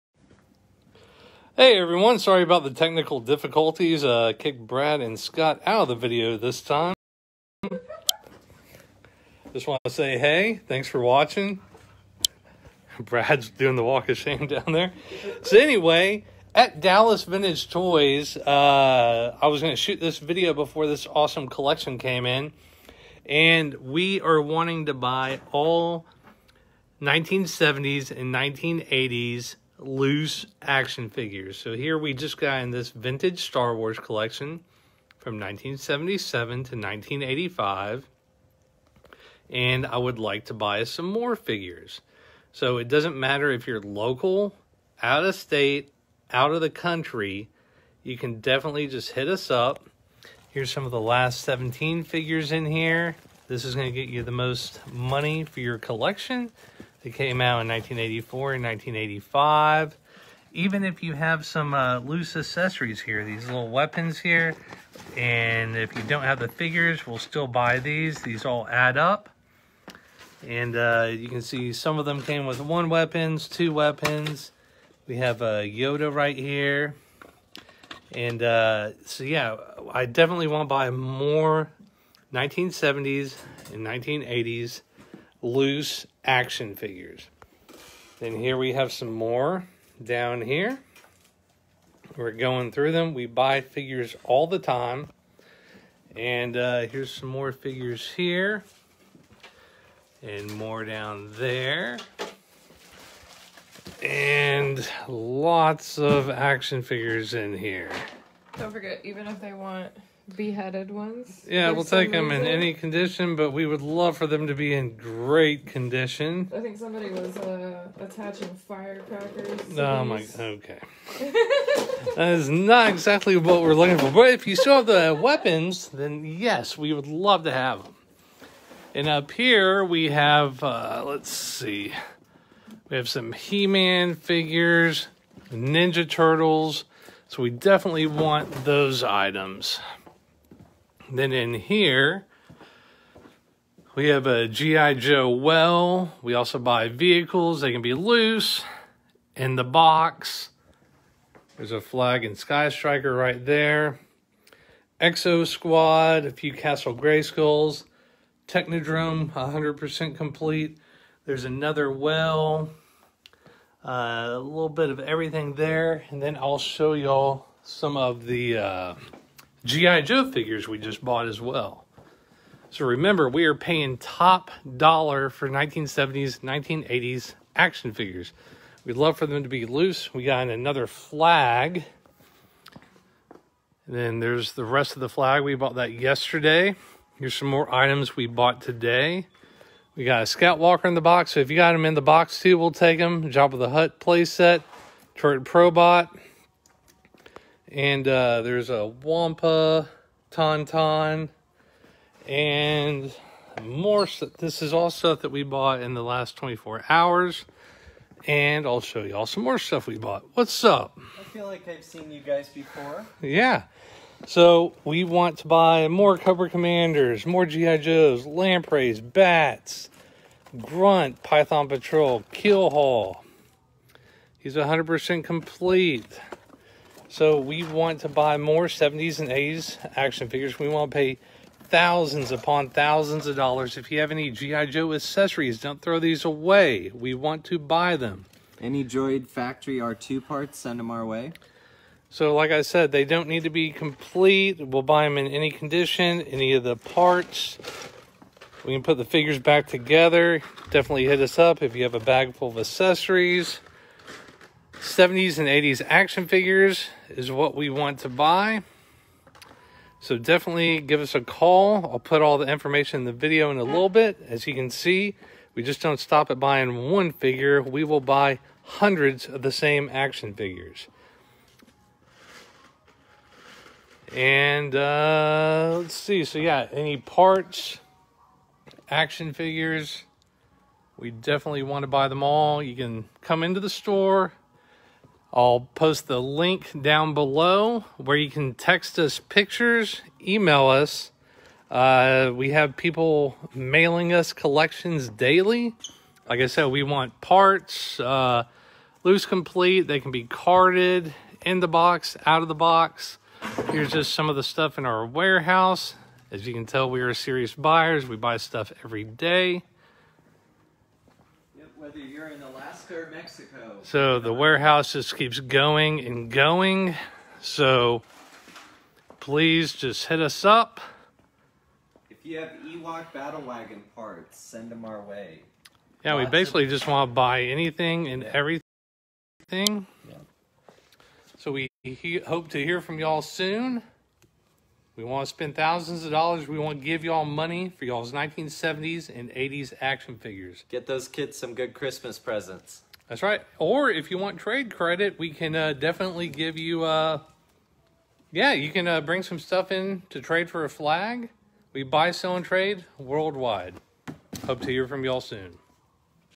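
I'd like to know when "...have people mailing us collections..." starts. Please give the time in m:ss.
4:52.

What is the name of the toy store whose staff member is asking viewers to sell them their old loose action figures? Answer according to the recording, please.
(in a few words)
Dallas Vintage Toys.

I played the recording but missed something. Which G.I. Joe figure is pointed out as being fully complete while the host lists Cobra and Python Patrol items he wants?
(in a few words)
Keel-Haul.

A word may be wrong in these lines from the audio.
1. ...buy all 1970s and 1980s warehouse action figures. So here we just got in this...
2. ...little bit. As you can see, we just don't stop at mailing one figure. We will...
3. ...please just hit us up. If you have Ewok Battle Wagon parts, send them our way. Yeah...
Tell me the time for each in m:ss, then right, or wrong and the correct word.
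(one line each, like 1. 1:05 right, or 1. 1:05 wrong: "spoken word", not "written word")
1. 0:24 wrong: "loose", not "warehouse"
2. 4:23 wrong: "buying", not "mailing"
3. 5:19 right.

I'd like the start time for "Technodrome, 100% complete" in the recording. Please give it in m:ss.
2:38.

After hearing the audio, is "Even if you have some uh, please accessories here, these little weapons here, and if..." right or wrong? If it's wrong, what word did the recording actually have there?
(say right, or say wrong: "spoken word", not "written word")
wrong: "loose", not "please".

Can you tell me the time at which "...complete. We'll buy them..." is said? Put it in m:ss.
4:03.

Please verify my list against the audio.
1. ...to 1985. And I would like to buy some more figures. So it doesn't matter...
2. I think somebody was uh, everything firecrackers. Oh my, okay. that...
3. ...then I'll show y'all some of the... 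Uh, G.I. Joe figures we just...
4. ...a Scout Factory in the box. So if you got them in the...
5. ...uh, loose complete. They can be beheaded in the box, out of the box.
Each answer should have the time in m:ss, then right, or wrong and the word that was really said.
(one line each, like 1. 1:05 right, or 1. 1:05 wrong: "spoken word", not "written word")
1. 0:36 right
2. 1:56 wrong: "attaching", not "everything"
3. 2:46 right
4. 3:10 wrong: "Walker", not "Factory"
5. 4:58 wrong: "carded", not "beheaded".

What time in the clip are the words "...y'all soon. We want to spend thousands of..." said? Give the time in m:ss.
5:32.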